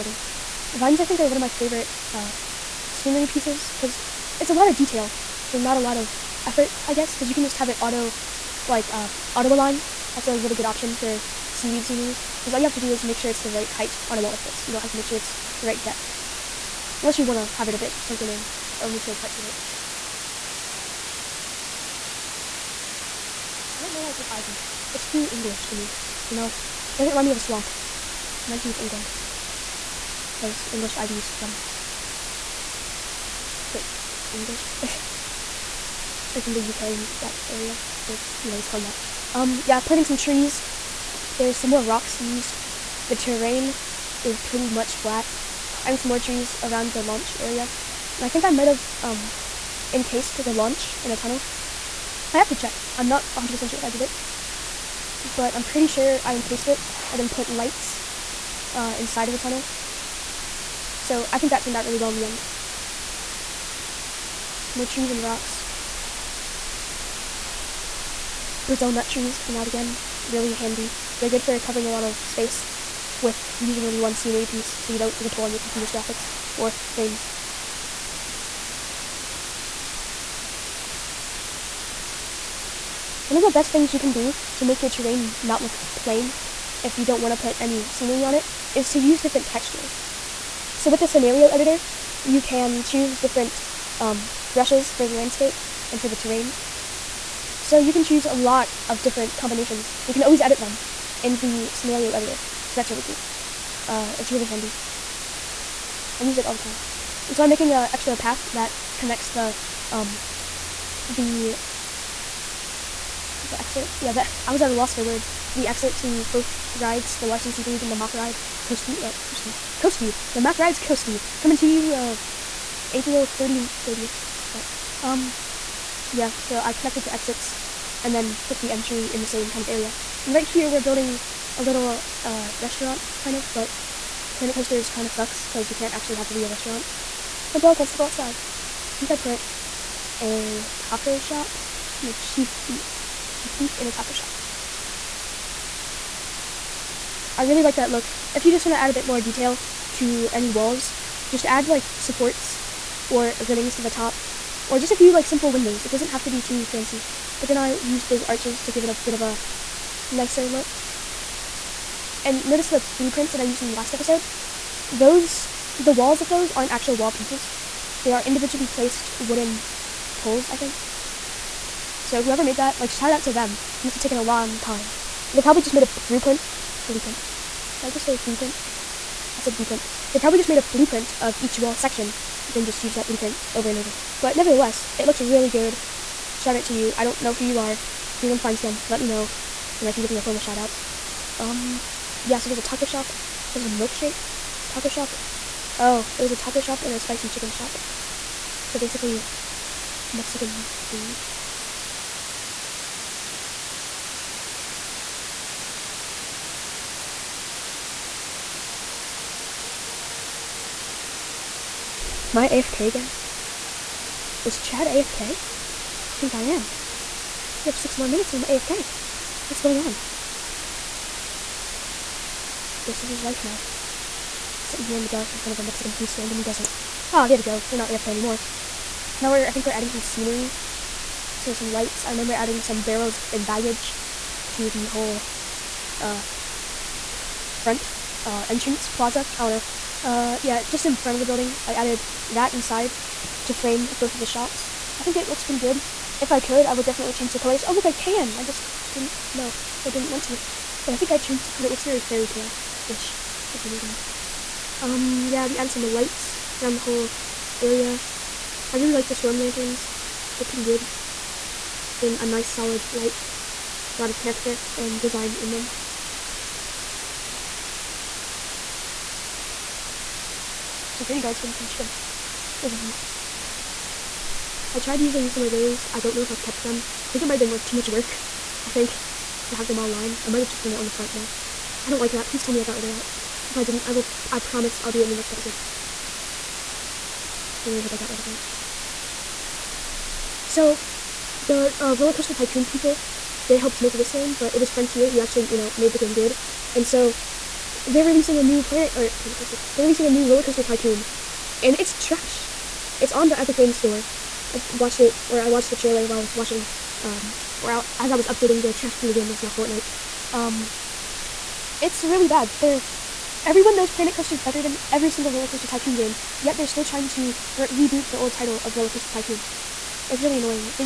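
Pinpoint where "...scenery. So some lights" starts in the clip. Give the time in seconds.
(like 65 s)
230 s.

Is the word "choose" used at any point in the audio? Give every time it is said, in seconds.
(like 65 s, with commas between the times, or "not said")
92 s, 98 s.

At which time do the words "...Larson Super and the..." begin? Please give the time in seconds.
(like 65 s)
117 s.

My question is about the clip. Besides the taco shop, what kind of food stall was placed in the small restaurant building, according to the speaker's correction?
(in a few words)
spicy chicken shop.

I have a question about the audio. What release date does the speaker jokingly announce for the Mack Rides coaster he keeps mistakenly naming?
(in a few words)
April 30.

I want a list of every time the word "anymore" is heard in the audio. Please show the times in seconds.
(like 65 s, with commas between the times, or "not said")
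228 s.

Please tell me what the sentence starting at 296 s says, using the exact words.
And so, they're releasing a new planet or planet coaster.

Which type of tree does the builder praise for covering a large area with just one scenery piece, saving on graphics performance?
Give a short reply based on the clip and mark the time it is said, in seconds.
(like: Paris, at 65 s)
Brazil nut trees, at 68 s.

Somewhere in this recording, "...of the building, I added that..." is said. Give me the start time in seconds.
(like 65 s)
241 s.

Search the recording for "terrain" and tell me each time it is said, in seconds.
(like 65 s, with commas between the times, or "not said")
43 s, 84 s, 96 s.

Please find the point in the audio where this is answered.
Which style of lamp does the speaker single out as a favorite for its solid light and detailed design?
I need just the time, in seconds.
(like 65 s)
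259 s.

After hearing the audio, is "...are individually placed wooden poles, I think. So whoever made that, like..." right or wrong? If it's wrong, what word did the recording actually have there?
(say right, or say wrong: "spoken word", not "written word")
right.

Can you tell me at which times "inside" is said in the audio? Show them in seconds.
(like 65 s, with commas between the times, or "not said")
58 s, 242 s.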